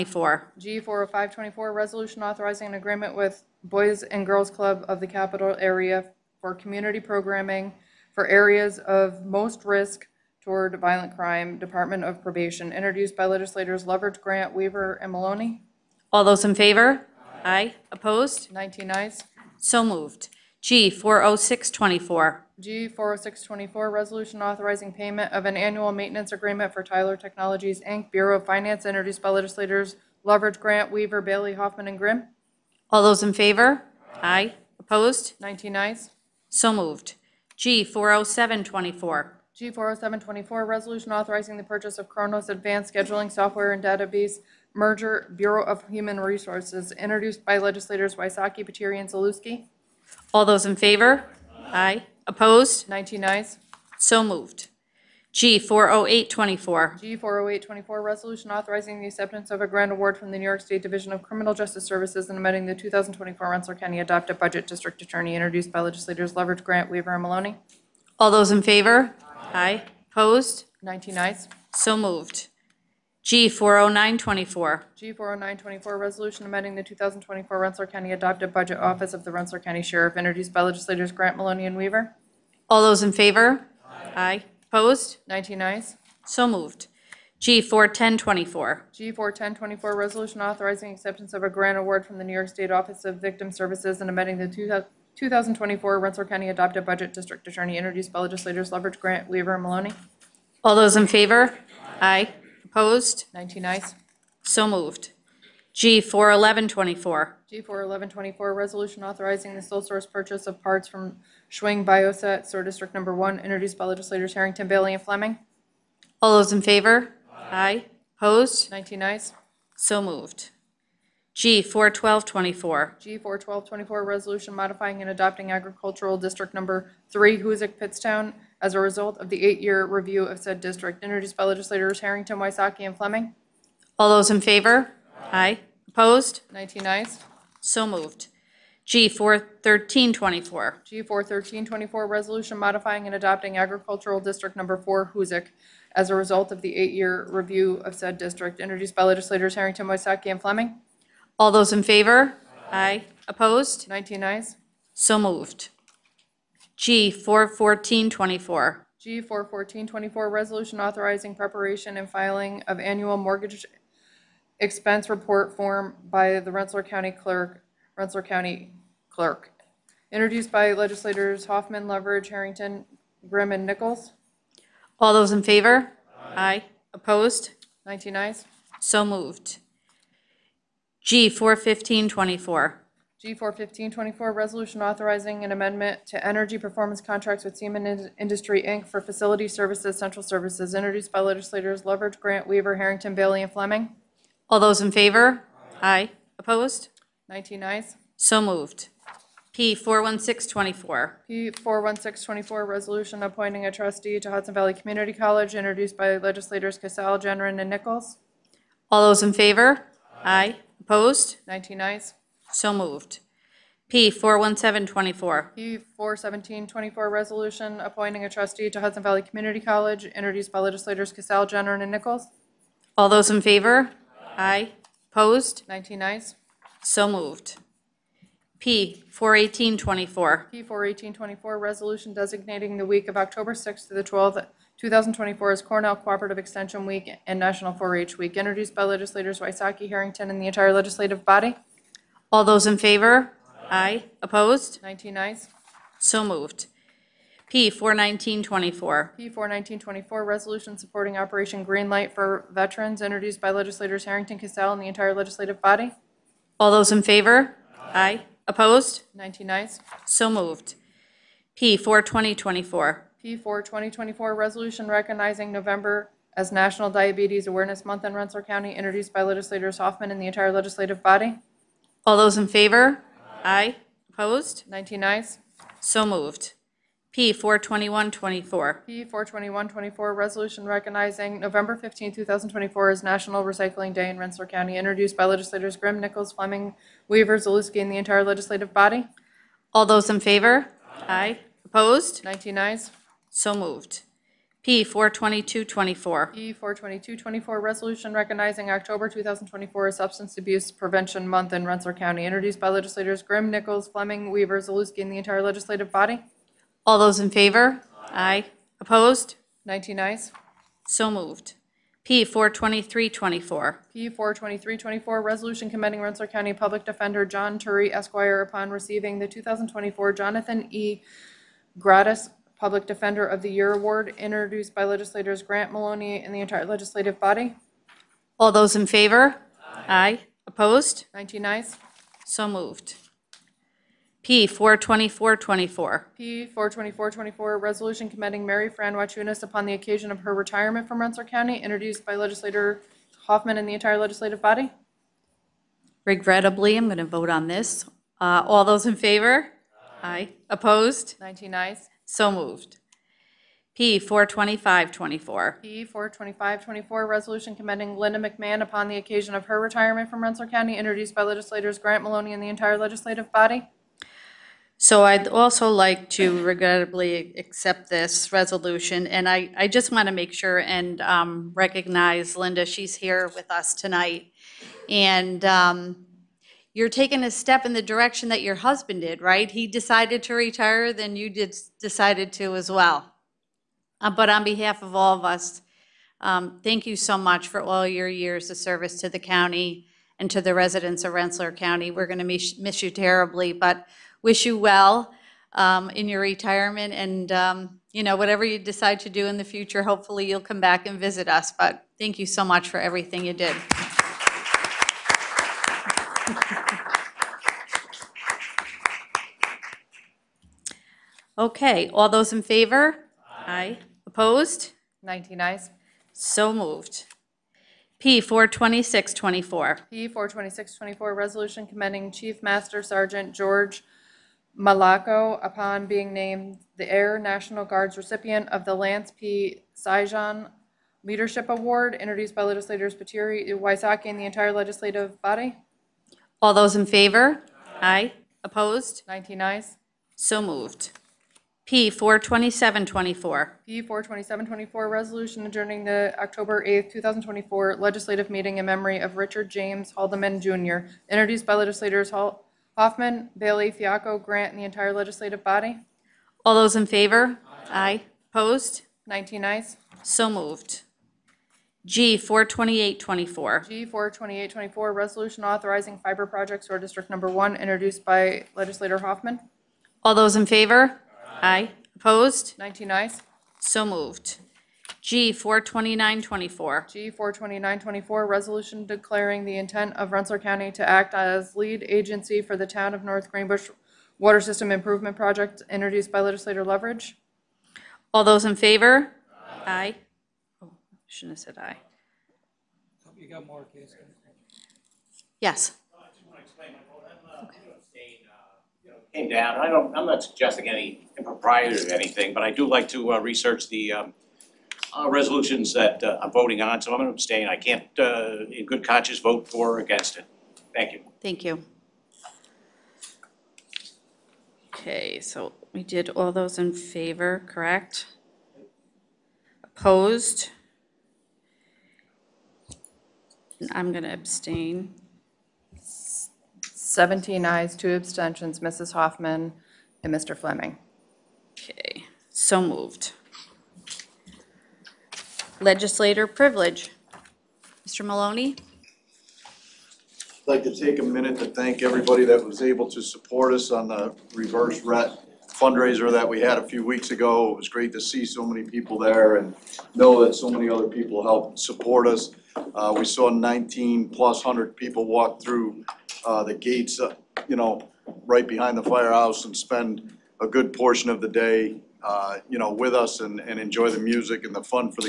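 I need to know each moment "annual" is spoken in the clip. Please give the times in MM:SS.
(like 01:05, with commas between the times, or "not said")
00:25, 02:42.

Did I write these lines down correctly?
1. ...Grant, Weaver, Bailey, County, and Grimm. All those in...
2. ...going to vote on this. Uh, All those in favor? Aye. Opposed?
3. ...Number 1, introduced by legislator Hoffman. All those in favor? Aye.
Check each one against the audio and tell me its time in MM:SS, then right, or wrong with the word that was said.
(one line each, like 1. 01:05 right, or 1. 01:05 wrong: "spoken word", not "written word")
1. 00:30 wrong: "Hoffman", not "County"
2. 05:46 right
3. 07:47 right.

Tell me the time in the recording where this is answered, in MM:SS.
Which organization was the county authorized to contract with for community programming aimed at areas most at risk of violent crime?
00:03.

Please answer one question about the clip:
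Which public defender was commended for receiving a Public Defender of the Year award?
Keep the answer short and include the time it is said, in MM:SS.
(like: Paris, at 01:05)
John Turi, at 05:17.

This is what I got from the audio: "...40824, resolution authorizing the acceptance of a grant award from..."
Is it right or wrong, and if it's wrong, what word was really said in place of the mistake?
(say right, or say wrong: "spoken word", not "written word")
right.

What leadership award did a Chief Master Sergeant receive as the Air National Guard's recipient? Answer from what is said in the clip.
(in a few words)
Lance P. Sijan Leadership Award.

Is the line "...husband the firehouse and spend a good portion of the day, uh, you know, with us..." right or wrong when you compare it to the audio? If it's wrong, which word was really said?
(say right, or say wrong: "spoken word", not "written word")
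wrong: "behind", not "husband".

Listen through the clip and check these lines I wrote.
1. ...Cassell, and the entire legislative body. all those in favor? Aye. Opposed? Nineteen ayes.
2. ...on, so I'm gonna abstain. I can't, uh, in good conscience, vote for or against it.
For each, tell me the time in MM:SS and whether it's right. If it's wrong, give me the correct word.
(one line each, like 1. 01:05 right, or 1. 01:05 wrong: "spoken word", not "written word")
1. 04:14 right
2. 08:26 right.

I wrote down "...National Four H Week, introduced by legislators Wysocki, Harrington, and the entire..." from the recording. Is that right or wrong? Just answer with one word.
right.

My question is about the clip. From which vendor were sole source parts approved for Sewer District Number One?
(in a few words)
Schwing Bioset.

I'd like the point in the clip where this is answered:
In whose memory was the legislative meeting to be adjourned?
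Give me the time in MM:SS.
07:29.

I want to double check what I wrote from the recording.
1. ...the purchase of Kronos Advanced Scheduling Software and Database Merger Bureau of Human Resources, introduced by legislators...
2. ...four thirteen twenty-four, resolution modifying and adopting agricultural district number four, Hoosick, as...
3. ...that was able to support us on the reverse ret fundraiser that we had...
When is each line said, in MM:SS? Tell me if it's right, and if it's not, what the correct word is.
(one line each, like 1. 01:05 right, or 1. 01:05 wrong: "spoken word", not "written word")
1. 00:41 right
2. 02:21 right
3. 09:02 right.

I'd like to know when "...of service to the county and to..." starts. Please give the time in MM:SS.
06:28.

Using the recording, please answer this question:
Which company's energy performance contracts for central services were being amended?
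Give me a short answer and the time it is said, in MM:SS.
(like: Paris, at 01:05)
Siemens Industry, Inc., at 03:07.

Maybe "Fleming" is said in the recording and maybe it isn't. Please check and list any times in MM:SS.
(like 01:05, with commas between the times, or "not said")
01:55, 02:12, 02:30, 03:13, 04:46, 05:03, 08:50.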